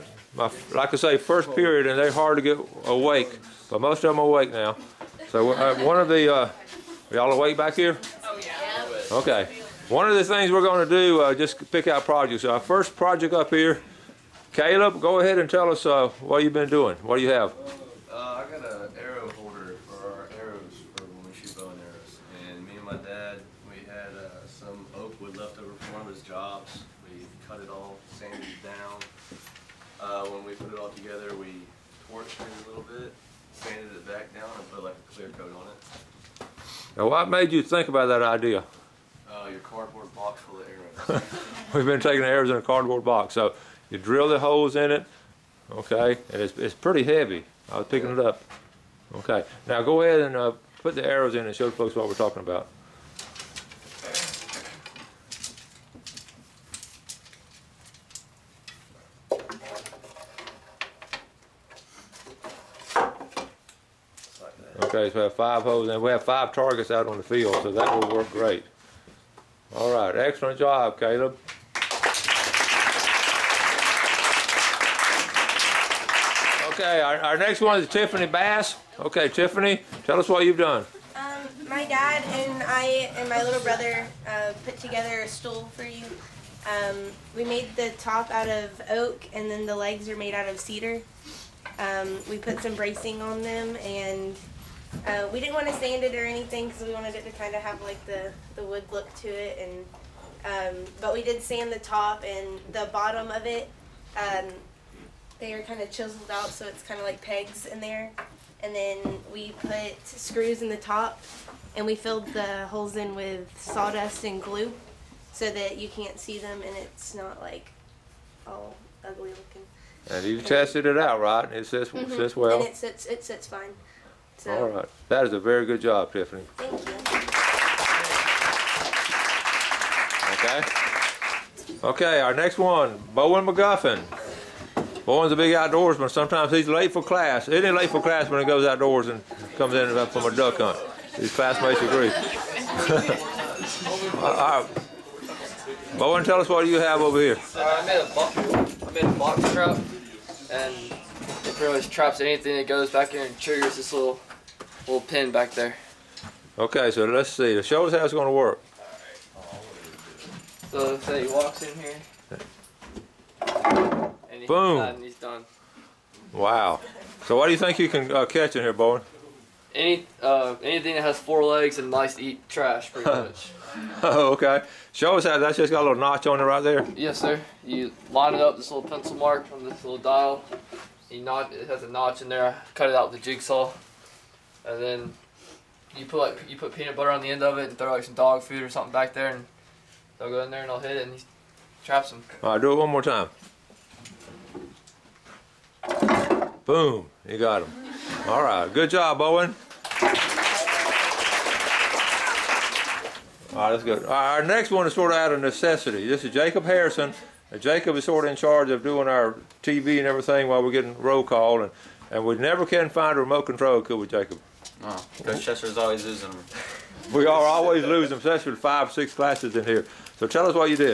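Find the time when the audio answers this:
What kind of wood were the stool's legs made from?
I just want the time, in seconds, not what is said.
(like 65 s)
90 s.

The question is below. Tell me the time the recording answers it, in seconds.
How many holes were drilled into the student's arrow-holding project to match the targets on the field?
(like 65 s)
65 s.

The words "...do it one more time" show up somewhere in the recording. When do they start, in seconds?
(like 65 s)
192 s.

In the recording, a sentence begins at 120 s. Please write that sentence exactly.
And you tested it out, right?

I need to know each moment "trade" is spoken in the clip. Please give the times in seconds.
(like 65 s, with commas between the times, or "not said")
not said.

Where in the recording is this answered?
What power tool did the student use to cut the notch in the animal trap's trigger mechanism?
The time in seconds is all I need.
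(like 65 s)
183 s.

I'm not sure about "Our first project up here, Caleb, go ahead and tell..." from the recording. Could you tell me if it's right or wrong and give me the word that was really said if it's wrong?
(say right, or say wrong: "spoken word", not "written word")
right.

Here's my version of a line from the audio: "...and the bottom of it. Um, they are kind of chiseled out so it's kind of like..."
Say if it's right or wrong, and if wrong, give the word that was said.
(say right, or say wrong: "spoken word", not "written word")
right.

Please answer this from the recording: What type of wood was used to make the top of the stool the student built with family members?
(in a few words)
Oak.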